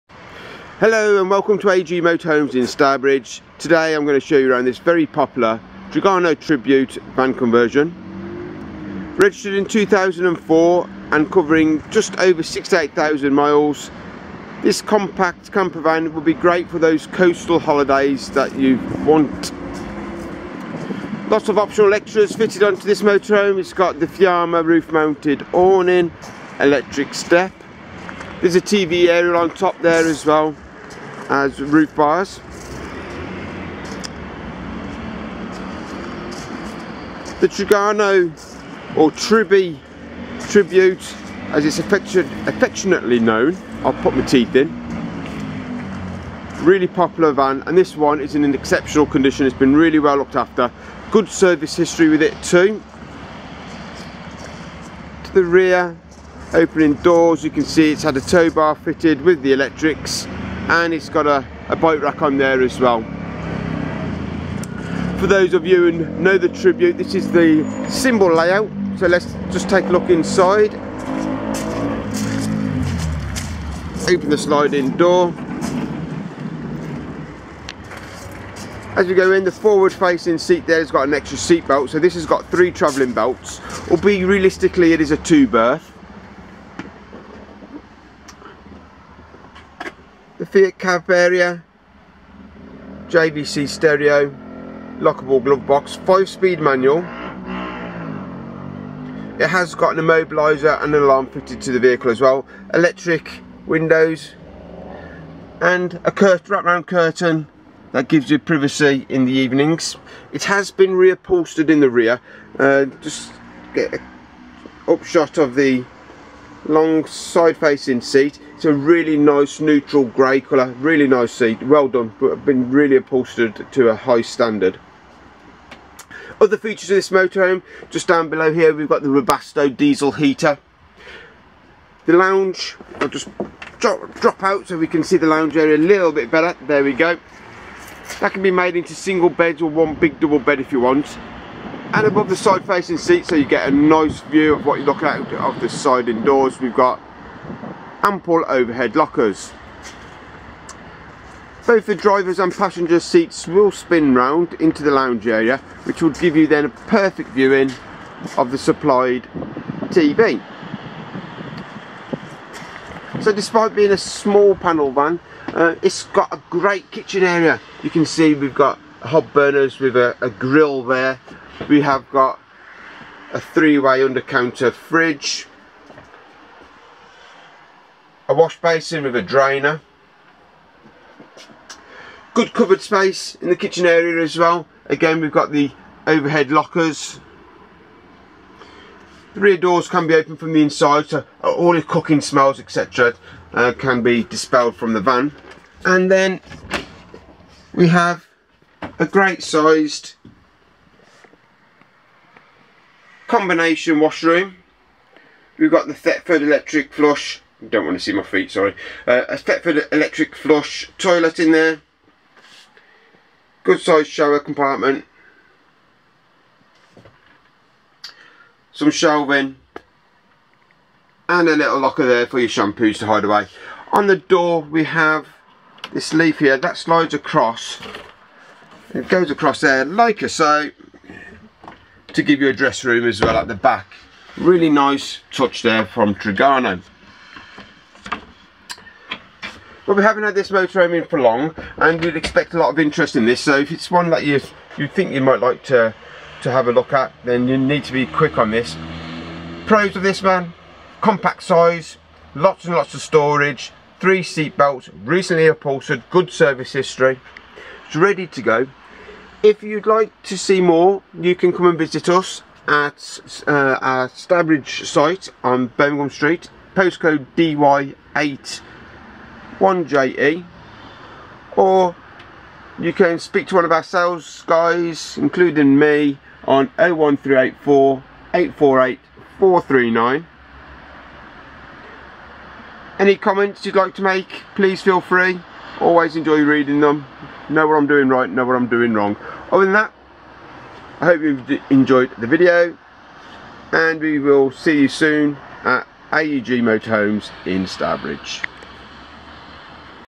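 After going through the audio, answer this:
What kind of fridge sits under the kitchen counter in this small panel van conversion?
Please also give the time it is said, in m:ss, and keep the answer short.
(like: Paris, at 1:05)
three-way, at 2:53.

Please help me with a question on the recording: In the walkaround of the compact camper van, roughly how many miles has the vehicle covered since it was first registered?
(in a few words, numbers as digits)
68,000.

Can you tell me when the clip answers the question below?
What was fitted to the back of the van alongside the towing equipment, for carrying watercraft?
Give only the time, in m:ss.
1:01.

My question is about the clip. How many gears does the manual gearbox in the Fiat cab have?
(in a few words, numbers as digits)
5.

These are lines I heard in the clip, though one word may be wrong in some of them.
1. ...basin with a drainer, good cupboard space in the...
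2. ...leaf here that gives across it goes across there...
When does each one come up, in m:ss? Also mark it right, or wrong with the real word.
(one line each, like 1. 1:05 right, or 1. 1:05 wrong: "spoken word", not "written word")
1. 2:58 right
2. 3:46 wrong: "slides", not "gives".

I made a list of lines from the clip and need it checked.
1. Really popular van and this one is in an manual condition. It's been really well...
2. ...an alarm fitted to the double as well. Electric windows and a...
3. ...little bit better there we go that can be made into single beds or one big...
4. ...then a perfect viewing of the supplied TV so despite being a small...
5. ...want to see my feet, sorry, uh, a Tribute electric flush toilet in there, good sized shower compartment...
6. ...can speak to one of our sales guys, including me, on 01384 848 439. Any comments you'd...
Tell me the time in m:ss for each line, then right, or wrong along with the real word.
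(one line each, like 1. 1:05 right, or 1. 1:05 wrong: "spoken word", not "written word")
1. 0:46 wrong: "exceptional", not "manual"
2. 1:40 wrong: "vehicle", not "double"
3. 2:15 right
4. 2:36 right
5. 3:27 wrong: "Thetford", not "Tribute"
6. 4:32 right.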